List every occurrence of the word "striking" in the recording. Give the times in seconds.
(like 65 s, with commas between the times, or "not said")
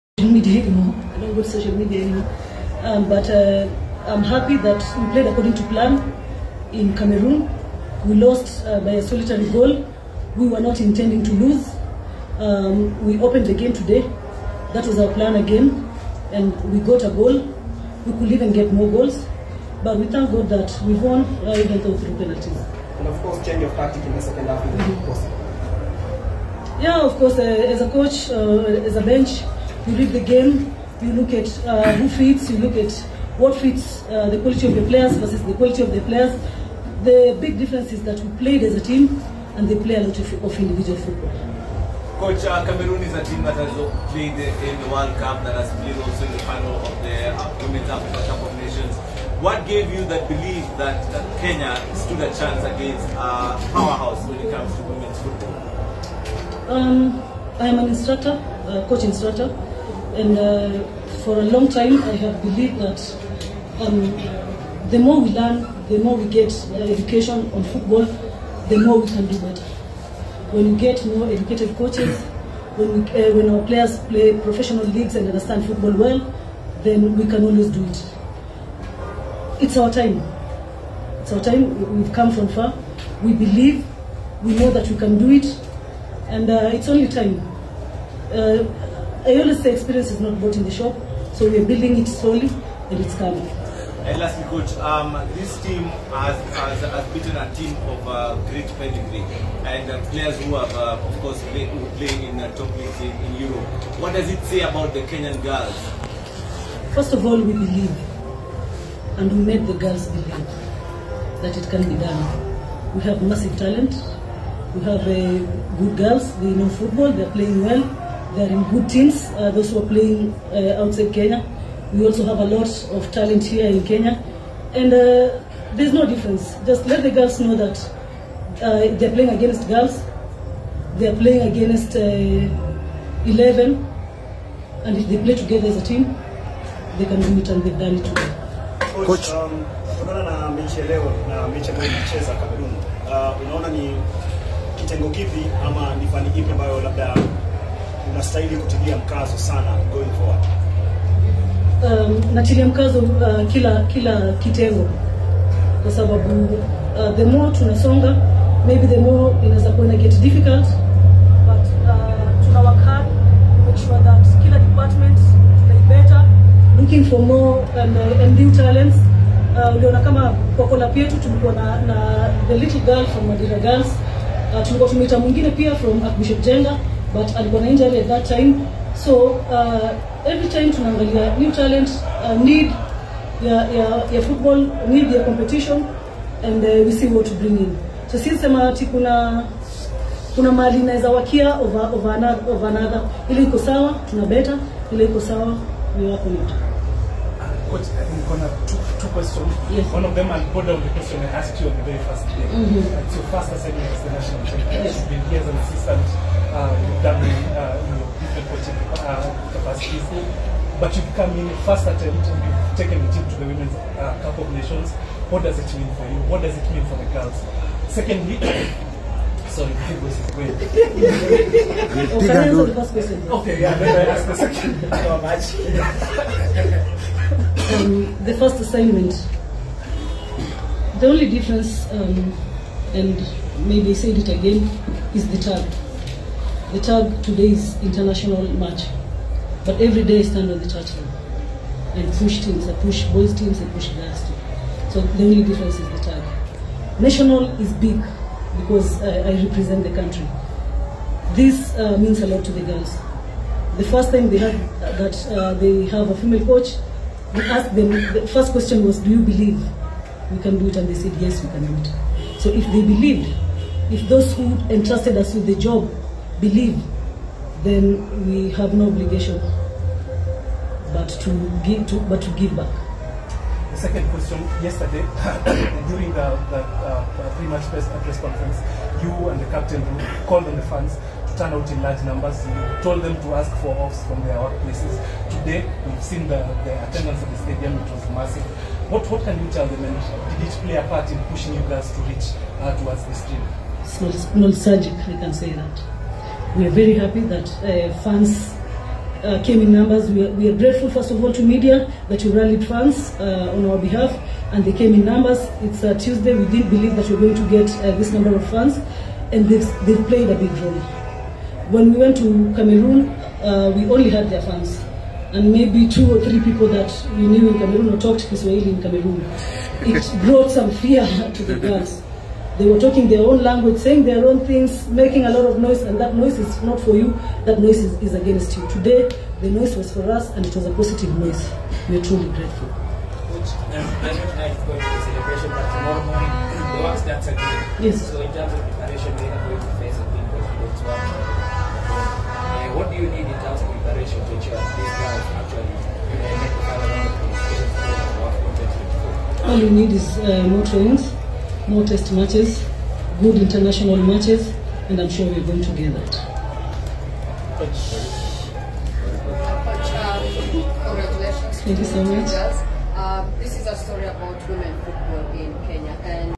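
not said.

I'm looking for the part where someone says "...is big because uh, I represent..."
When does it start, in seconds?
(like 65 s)
247 s.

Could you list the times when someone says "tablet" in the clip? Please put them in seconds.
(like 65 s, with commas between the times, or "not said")
not said.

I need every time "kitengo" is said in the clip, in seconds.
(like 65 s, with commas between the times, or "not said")
144 s, 154 s.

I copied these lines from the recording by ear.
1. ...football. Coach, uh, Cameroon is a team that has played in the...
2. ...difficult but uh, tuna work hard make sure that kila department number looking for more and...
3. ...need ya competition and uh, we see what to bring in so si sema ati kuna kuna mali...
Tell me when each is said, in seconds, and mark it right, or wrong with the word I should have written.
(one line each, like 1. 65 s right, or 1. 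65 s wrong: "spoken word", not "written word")
1. 40 s right
2. 160 s wrong: "better", not "number"
3. 184 s right.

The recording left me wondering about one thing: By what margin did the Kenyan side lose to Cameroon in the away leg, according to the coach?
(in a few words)
A solitary goal.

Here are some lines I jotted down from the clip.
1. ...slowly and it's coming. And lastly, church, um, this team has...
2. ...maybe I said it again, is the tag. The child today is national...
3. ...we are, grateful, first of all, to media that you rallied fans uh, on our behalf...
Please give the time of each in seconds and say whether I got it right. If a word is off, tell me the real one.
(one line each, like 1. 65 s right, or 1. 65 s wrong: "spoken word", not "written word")
1. 92 s wrong: "coach", not "church"
2. 233 s wrong: "international", not "national"
3. 300 s right.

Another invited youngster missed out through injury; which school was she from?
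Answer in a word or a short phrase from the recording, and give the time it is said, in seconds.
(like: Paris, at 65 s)
Archbishop Jenga, at 176 s.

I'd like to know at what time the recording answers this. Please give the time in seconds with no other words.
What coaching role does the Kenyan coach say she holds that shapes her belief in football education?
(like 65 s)
58 s.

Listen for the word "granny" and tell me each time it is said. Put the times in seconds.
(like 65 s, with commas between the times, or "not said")
not said.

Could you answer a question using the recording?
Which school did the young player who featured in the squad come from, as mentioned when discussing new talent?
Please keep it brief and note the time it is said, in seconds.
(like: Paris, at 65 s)
Madira Girls, at 173 s.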